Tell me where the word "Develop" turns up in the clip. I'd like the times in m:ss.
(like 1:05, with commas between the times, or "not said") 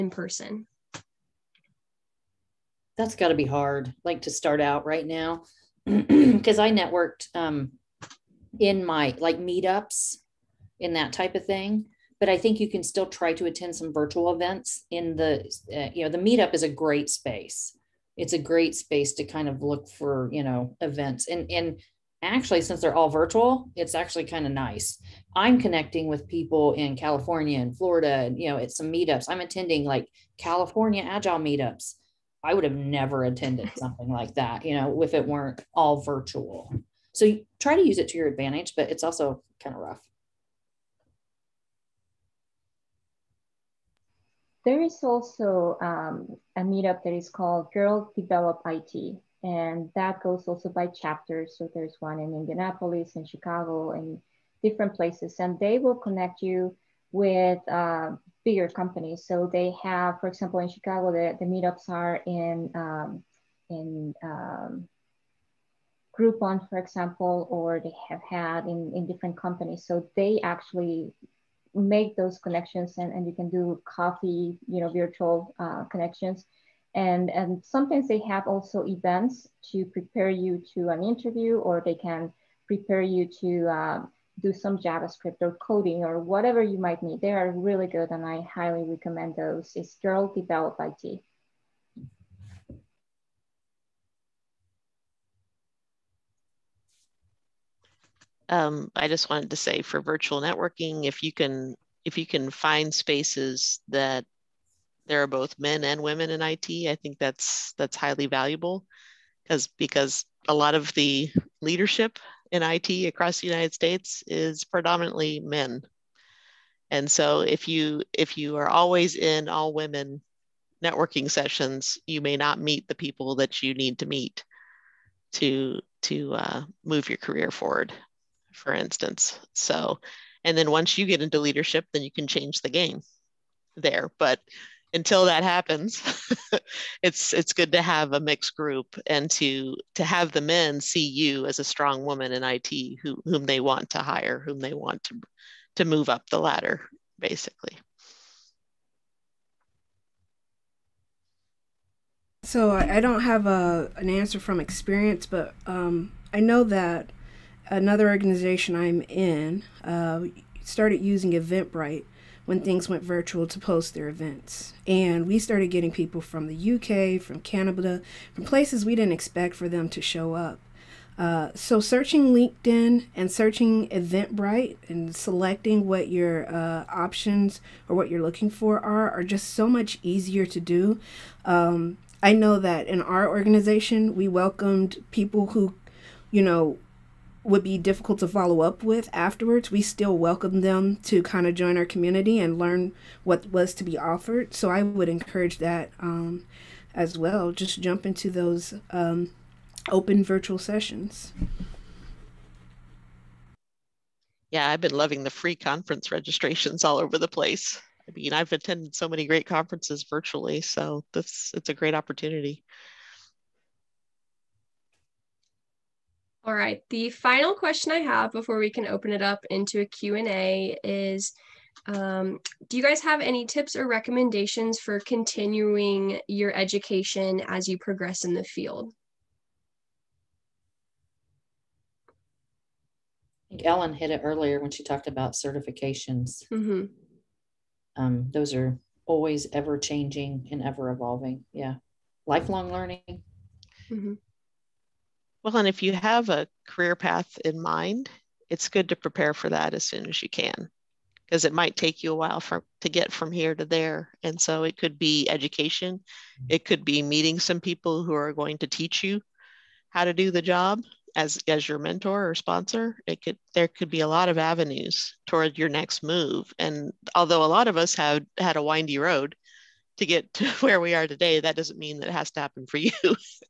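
0:48, 1:30.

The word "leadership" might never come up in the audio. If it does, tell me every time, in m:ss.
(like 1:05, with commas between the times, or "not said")
1:51, 2:11.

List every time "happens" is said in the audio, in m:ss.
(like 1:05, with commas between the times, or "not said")
2:15, 4:32.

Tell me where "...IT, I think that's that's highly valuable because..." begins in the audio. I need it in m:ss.
1:46.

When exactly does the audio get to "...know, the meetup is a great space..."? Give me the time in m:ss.
0:16.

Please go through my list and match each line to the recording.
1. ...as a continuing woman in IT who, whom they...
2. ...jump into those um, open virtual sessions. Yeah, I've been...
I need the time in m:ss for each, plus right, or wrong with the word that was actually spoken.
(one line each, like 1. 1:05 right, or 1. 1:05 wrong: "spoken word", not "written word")
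1. 2:21 wrong: "strong", not "continuing"
2. 3:17 right.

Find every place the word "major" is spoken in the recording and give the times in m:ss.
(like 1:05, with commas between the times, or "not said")
not said.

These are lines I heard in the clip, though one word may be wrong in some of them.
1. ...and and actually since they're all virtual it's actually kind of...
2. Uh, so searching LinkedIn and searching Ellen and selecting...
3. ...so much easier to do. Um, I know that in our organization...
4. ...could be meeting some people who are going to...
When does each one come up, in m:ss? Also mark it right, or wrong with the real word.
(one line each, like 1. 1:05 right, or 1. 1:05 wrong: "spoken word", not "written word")
1. 0:21 right
2. 2:51 wrong: "Eventbrite", not "Ellen"
3. 2:59 right
4. 4:16 right.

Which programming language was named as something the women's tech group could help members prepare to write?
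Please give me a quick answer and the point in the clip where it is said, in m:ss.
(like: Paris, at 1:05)
JavaScript, at 1:24.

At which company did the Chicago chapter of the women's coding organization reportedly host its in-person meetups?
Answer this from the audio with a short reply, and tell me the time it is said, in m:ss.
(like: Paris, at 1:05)
Groupon, at 1:06.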